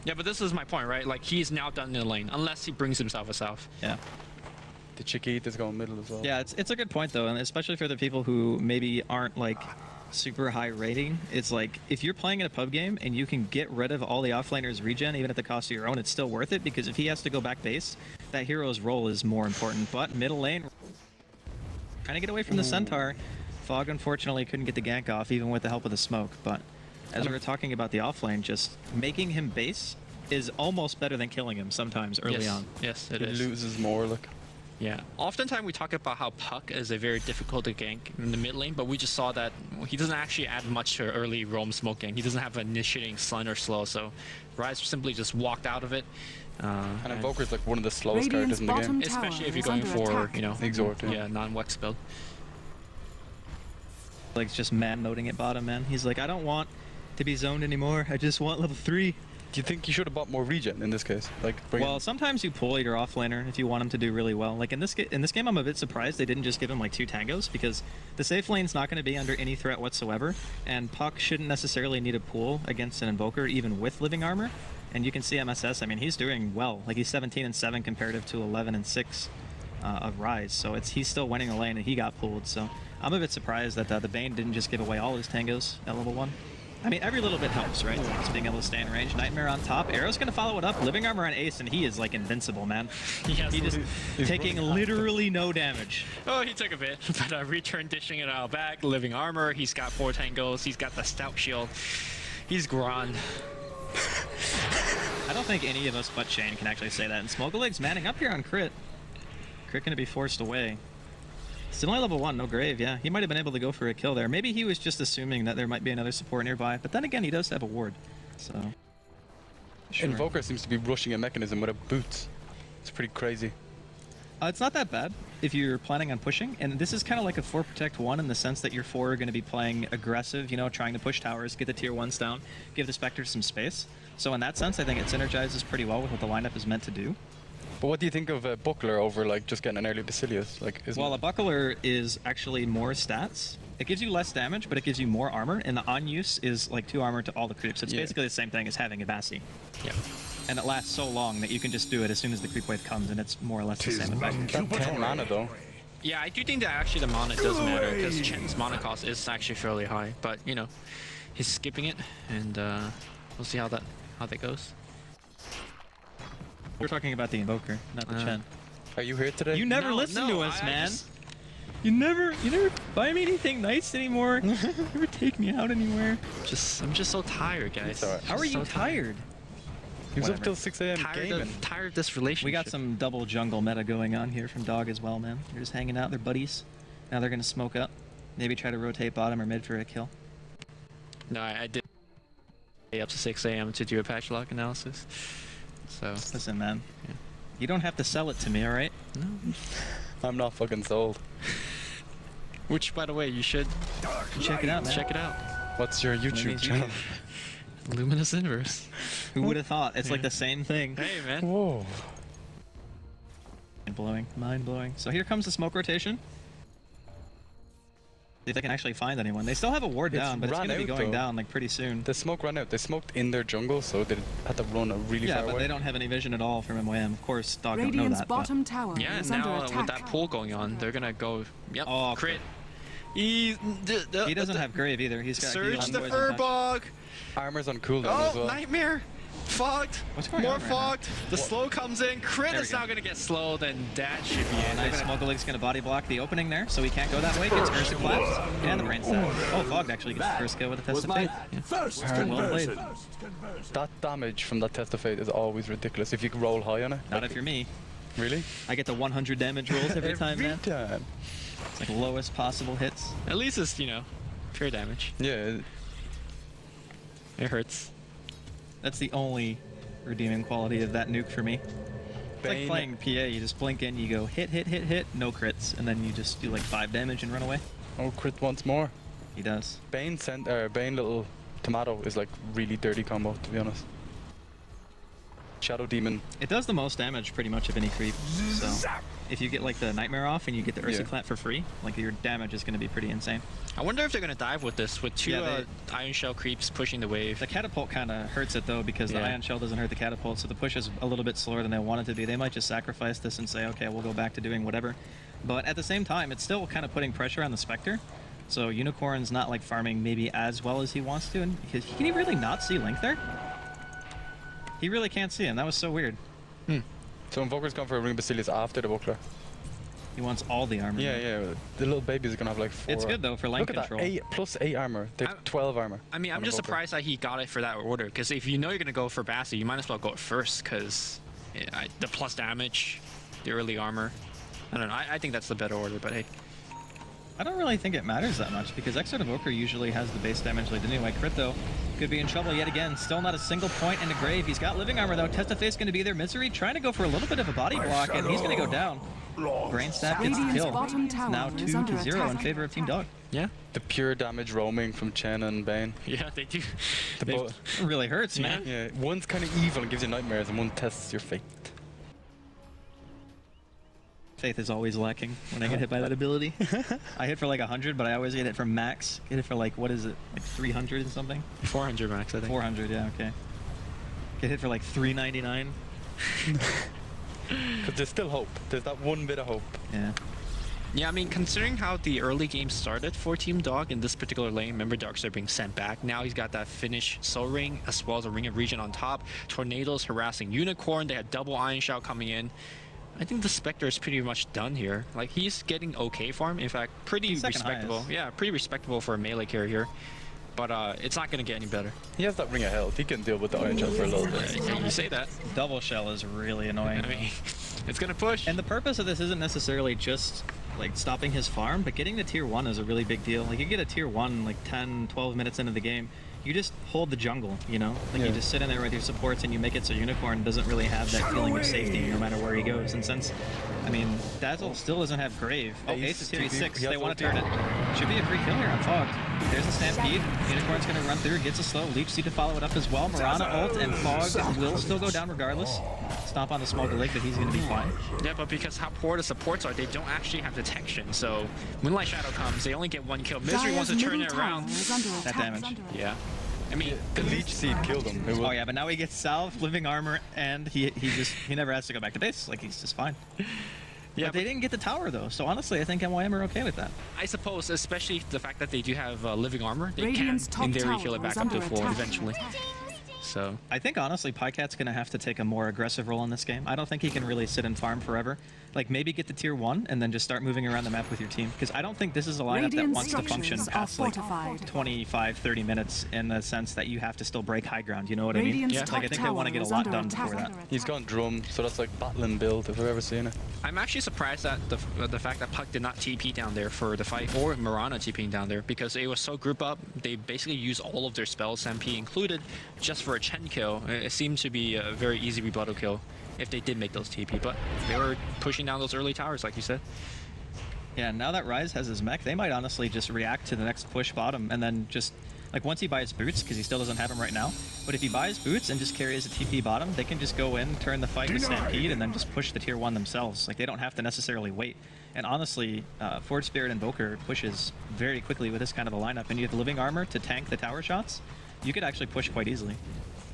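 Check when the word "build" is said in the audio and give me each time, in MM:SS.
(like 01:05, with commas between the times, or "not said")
00:51, 08:02.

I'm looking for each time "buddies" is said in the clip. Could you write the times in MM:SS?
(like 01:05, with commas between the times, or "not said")
03:06.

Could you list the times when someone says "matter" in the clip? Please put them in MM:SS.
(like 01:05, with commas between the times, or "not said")
02:37, 05:38, 07:02.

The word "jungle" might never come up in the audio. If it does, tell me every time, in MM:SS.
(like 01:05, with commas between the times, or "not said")
03:03, 03:43, 06:57.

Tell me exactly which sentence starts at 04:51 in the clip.
Clat for free, like your damage is going to be pretty insane.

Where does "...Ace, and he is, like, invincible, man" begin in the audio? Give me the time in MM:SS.
01:31.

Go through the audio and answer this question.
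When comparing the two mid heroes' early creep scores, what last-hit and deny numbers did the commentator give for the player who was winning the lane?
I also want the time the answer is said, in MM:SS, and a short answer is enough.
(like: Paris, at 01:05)
17 and 7, at 01:17.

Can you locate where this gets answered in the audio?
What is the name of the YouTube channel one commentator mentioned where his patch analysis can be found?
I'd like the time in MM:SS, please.
03:27.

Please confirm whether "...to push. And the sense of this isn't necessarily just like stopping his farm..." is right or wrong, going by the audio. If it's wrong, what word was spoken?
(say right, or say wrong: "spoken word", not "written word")
wrong: "purpose", not "sense".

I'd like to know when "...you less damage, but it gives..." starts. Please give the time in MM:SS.
02:24.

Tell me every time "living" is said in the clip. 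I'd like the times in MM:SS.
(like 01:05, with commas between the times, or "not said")
01:13, 01:30, 01:38, 05:44, 07:29, 07:39, 08:39.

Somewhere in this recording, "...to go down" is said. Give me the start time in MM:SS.
05:48.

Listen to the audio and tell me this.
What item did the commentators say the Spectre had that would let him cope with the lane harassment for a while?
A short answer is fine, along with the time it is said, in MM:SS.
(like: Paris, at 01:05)
Ring of Health, at 06:42.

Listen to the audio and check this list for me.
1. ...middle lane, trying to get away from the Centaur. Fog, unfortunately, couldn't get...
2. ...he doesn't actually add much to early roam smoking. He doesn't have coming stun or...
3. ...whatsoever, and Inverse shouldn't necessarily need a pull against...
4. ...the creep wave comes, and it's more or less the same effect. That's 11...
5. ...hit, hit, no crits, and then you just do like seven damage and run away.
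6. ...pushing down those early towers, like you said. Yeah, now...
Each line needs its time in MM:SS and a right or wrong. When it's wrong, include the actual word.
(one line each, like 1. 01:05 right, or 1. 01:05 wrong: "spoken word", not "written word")
1. 00:20 right
2. 00:39 wrong: "initiating", not "coming"
3. 01:09 wrong: "Puck", not "Inverse"
4. 02:32 wrong: "10", not "11"
5. 04:34 wrong: "five", not "seven"
6. 08:18 right.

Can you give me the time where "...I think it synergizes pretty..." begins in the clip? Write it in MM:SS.
02:14.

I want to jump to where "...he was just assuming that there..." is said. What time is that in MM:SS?
01:54.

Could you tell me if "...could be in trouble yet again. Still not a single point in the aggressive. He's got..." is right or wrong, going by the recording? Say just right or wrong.
wrong.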